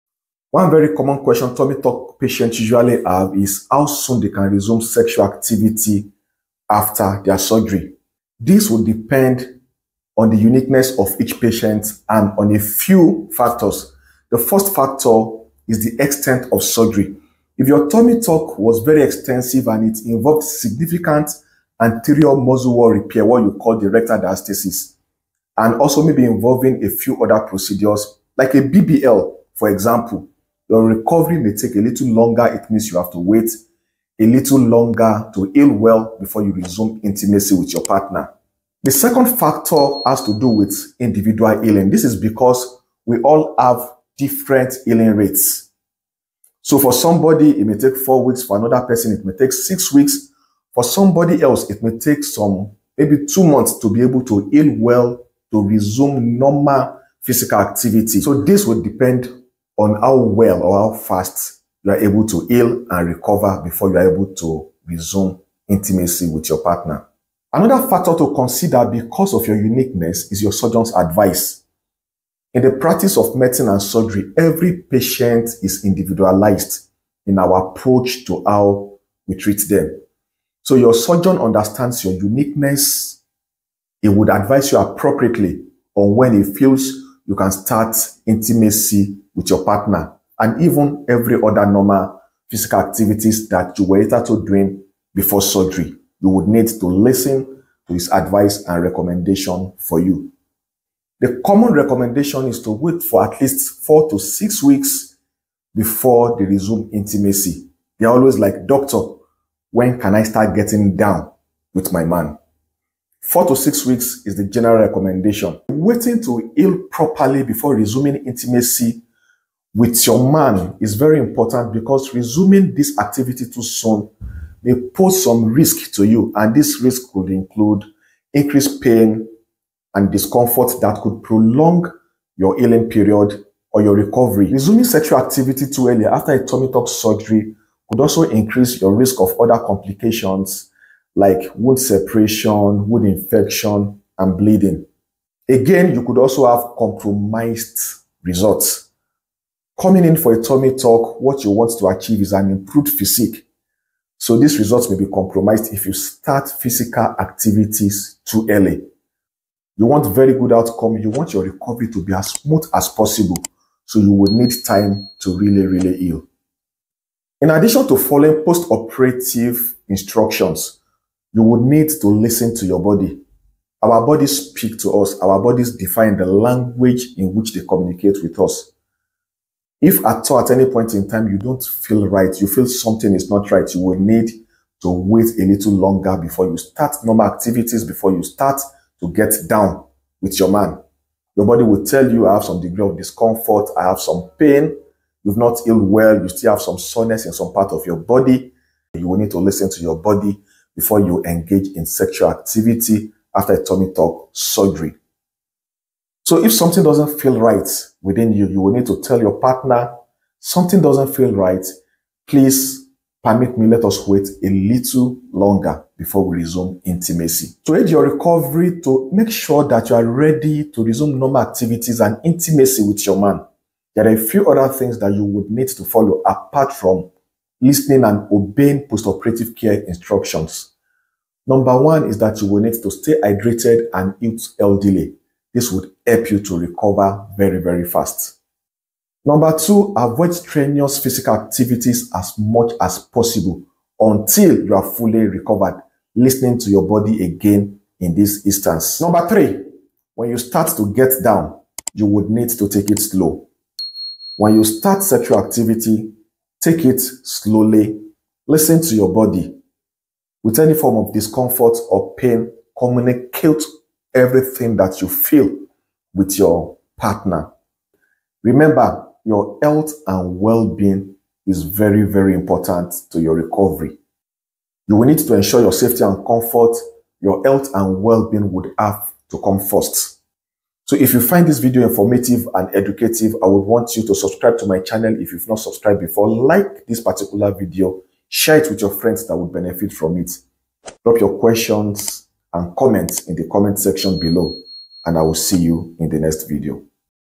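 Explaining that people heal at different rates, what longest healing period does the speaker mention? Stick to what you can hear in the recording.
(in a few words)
2 months.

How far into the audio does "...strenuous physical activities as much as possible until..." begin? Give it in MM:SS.
04:00.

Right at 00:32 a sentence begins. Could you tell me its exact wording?
It means you have to wait a little longer to heal well before you resume intimacy with your partner.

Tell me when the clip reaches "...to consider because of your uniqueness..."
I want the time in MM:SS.
01:08.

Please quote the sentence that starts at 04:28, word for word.
Remember, your health and well-being is very, very important to your recovery.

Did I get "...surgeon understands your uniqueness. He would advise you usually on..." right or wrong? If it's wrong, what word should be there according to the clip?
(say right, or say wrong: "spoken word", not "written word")
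wrong: "appropriately", not "usually".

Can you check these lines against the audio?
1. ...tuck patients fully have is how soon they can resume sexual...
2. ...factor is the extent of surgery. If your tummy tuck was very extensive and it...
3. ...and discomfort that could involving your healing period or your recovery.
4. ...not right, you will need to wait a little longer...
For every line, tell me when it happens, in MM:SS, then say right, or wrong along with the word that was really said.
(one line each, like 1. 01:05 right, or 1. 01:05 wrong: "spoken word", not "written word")
1. 00:01 wrong: "usually", not "fully"
2. 00:14 right
3. 02:09 wrong: "prolong", not "involving"
4. 03:03 right.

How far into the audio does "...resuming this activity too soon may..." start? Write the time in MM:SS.
02:02.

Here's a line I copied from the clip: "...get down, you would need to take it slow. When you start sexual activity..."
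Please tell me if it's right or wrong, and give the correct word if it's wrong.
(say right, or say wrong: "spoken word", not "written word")
right.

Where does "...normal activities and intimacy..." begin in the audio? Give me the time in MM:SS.
03:41.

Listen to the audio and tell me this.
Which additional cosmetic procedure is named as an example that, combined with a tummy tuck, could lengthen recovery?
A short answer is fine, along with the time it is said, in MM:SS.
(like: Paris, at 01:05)
BBL, at 00:28.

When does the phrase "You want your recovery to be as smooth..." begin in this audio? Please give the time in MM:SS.
02:40.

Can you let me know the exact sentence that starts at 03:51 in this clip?
Number one is that you will need to stay hydrated and eat LDL.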